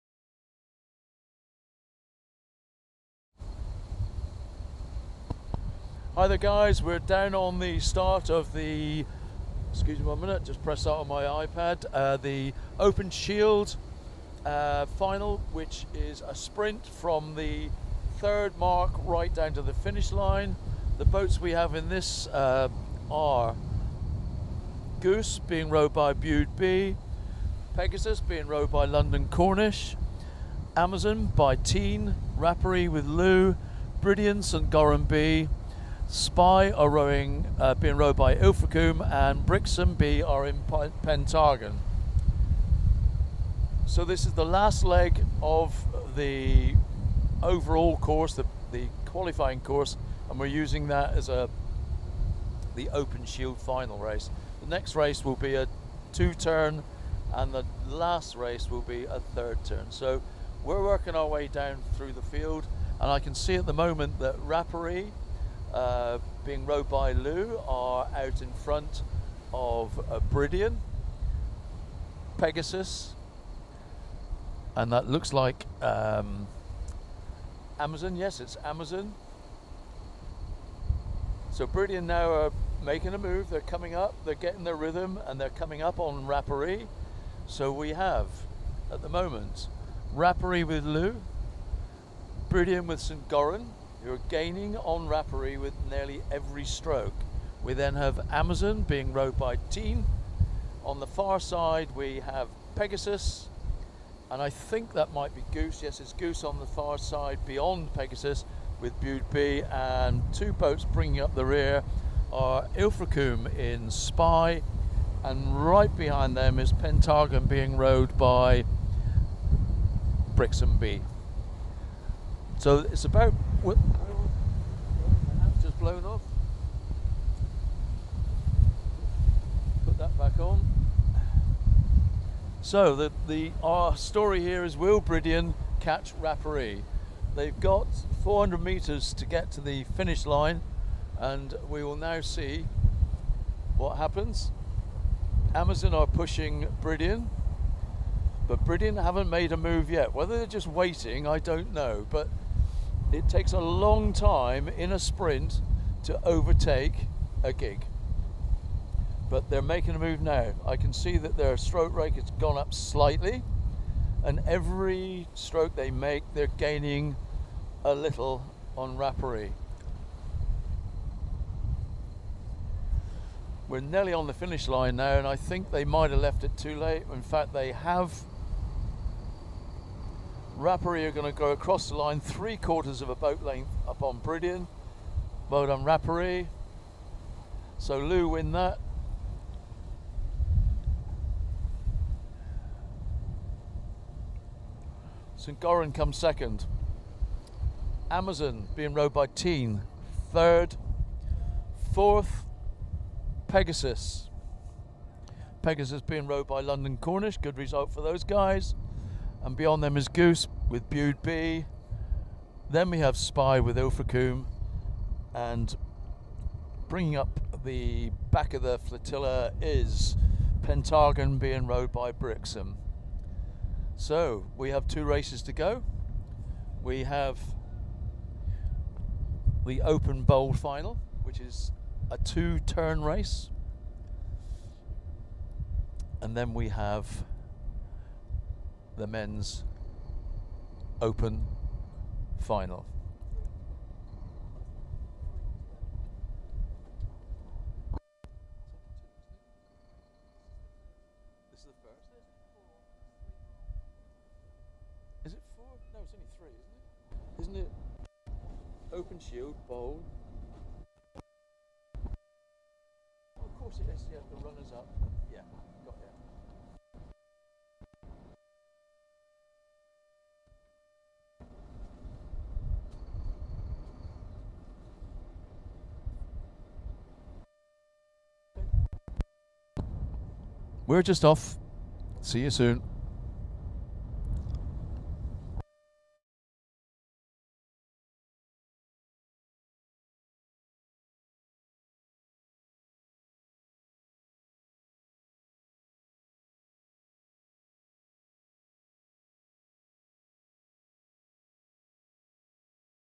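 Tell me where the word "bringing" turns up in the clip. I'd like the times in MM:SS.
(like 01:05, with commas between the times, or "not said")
01:50, 03:36.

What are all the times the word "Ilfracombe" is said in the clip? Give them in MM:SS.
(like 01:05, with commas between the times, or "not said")
00:38, 01:52, 03:33.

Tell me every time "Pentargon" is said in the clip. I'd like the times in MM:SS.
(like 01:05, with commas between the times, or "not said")
00:40, 01:56, 03:40.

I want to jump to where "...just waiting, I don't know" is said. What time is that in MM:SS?
02:30.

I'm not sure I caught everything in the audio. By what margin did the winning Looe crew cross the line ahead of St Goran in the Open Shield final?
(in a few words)
three quarters of a boat length.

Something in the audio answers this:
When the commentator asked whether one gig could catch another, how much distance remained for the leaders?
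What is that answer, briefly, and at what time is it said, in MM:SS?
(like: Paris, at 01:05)
400 meters, at 02:18.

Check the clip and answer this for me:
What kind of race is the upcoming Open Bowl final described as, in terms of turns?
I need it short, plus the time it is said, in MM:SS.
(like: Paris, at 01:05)
two turn race, at 03:52.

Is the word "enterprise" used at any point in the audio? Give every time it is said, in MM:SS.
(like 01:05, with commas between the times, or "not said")
not said.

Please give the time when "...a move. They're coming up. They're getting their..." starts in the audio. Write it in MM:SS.
01:23.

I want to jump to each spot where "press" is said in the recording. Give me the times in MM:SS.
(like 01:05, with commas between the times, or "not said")
00:10.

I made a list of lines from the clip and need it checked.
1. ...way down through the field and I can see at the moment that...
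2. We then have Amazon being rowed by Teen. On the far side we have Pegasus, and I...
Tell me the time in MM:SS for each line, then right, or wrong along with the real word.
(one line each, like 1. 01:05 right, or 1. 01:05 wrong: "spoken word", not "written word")
1. 01:01 right
2. 01:37 right.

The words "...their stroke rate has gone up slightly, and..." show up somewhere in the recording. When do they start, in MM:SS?
02:41.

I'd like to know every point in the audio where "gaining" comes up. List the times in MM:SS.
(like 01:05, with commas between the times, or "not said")
01:34, 02:46.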